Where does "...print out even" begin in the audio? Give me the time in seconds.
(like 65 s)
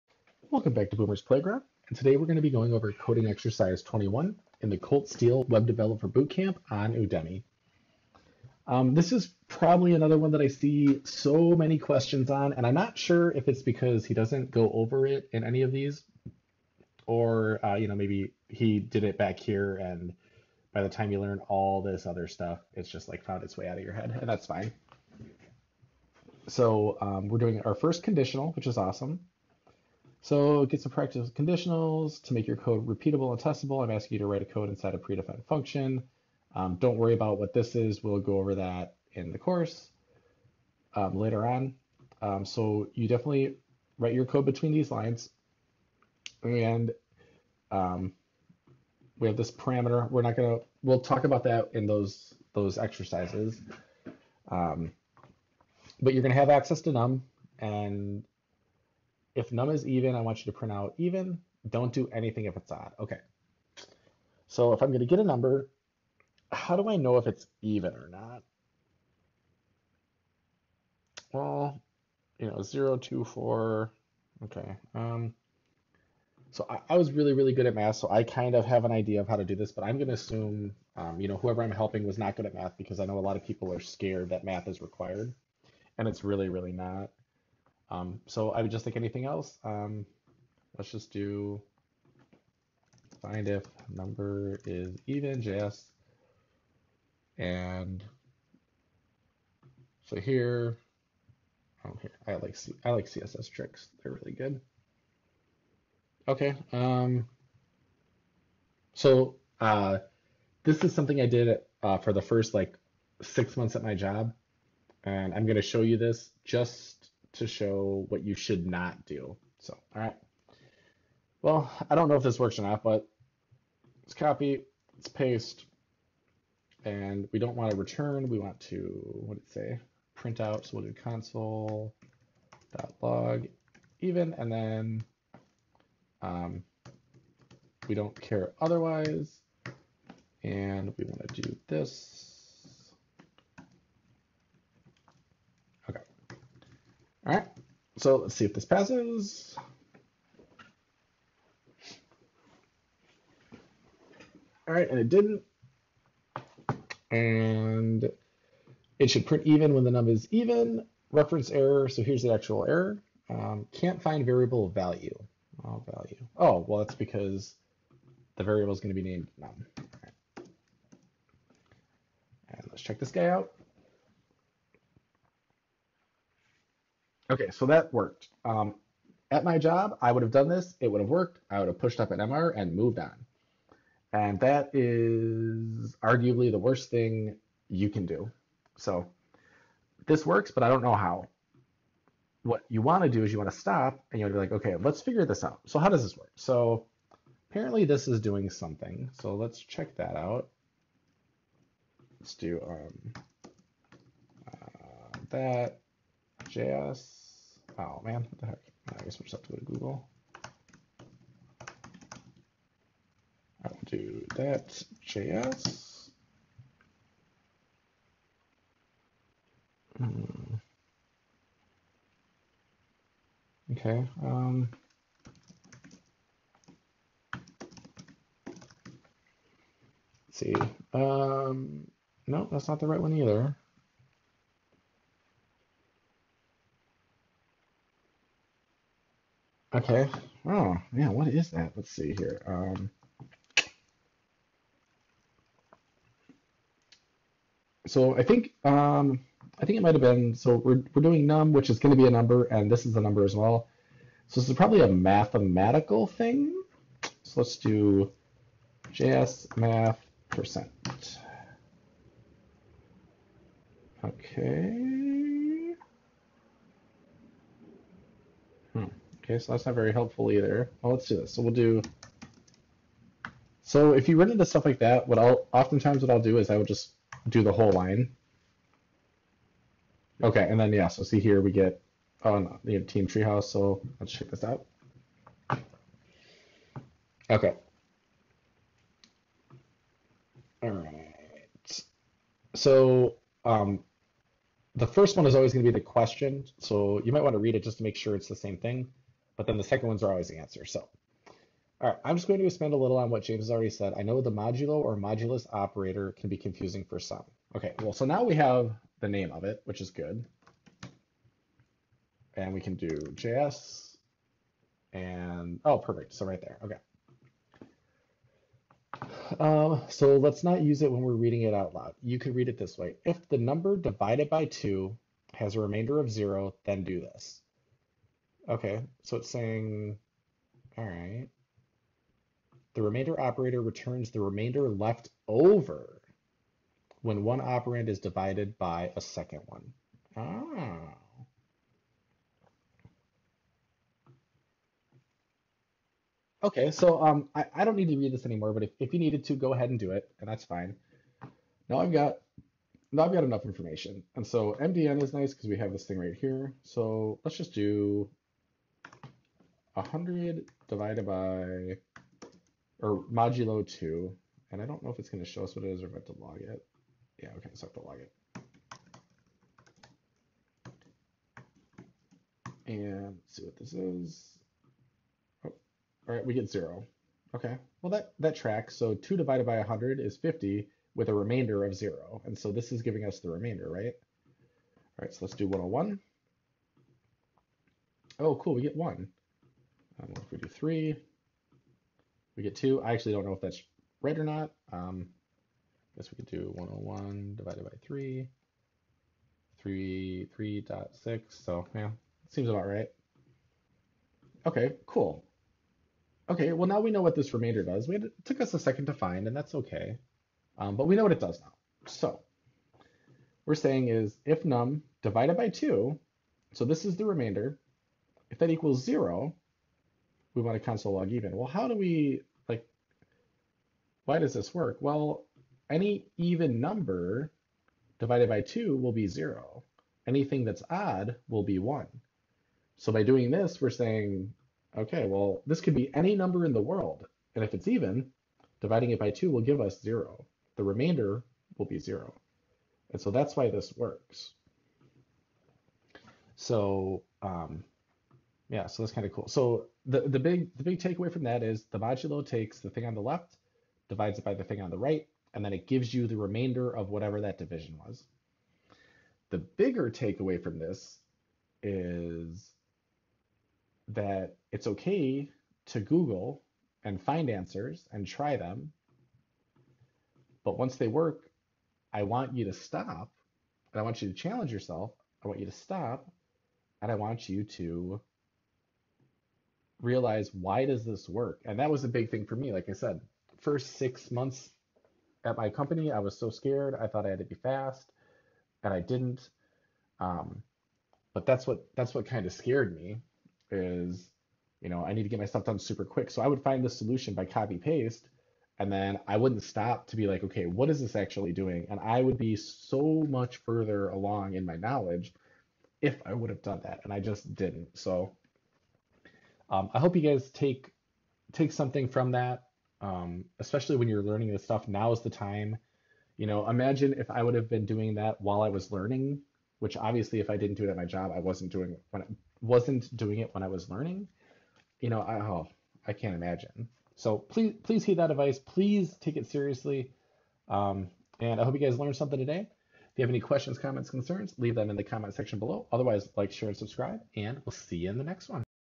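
60 s.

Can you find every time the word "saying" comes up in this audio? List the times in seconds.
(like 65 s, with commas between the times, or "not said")
329 s, 413 s, 433 s.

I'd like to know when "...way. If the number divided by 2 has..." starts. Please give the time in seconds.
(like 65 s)
322 s.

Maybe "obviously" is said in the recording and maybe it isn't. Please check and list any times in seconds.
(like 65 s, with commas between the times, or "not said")
519 s.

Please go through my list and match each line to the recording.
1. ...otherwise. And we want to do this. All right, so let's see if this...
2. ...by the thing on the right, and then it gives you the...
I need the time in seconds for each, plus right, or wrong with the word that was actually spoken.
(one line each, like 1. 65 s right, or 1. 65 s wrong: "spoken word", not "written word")
1. 138 s right
2. 454 s right.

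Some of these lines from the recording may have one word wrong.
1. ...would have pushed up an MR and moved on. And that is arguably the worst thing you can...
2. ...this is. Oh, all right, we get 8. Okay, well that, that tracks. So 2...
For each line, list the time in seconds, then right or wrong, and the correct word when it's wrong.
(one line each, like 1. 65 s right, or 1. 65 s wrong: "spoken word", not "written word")
1. 181 s right
2. 373 s wrong: "0", not "8".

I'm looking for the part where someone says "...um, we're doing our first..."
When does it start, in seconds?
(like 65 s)
26 s.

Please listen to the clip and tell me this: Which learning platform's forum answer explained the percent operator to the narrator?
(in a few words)
Team Treehouse.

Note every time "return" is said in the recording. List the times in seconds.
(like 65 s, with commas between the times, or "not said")
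127 s, 333 s.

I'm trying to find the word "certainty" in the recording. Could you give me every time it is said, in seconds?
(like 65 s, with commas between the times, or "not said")
not said.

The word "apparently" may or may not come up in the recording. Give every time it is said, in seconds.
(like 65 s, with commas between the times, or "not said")
197 s.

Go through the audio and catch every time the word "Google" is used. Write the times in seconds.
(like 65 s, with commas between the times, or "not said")
209 s, 465 s.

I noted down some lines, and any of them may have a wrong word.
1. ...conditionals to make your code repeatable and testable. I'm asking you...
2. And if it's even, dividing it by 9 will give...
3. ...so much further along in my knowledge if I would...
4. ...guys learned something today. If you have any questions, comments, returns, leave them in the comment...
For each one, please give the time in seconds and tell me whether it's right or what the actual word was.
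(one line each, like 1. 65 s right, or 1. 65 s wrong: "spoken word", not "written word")
1. 31 s right
2. 437 s wrong: "2", not "9"
3. 502 s right
4. 531 s wrong: "concerns", not "returns".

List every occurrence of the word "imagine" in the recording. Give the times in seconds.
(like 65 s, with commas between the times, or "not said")
516 s, 526 s.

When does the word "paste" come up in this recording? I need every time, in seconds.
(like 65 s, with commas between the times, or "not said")
125 s, 497 s.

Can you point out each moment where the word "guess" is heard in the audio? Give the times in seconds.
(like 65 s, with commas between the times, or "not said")
209 s, 396 s.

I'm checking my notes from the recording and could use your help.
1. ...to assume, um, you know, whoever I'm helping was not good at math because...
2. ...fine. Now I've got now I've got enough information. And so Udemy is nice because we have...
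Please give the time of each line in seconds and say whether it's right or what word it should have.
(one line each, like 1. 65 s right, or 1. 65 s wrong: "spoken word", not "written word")
1. 80 s right
2. 350 s wrong: "MDN", not "Udemy".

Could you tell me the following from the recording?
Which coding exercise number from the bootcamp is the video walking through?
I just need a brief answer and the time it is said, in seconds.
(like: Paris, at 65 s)
21, at 3 s.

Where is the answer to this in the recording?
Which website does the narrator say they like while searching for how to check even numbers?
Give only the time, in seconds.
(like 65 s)
103 s.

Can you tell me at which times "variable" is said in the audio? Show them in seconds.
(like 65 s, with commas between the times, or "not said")
164 s, 168 s.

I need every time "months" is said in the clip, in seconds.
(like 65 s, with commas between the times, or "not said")
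113 s, 484 s.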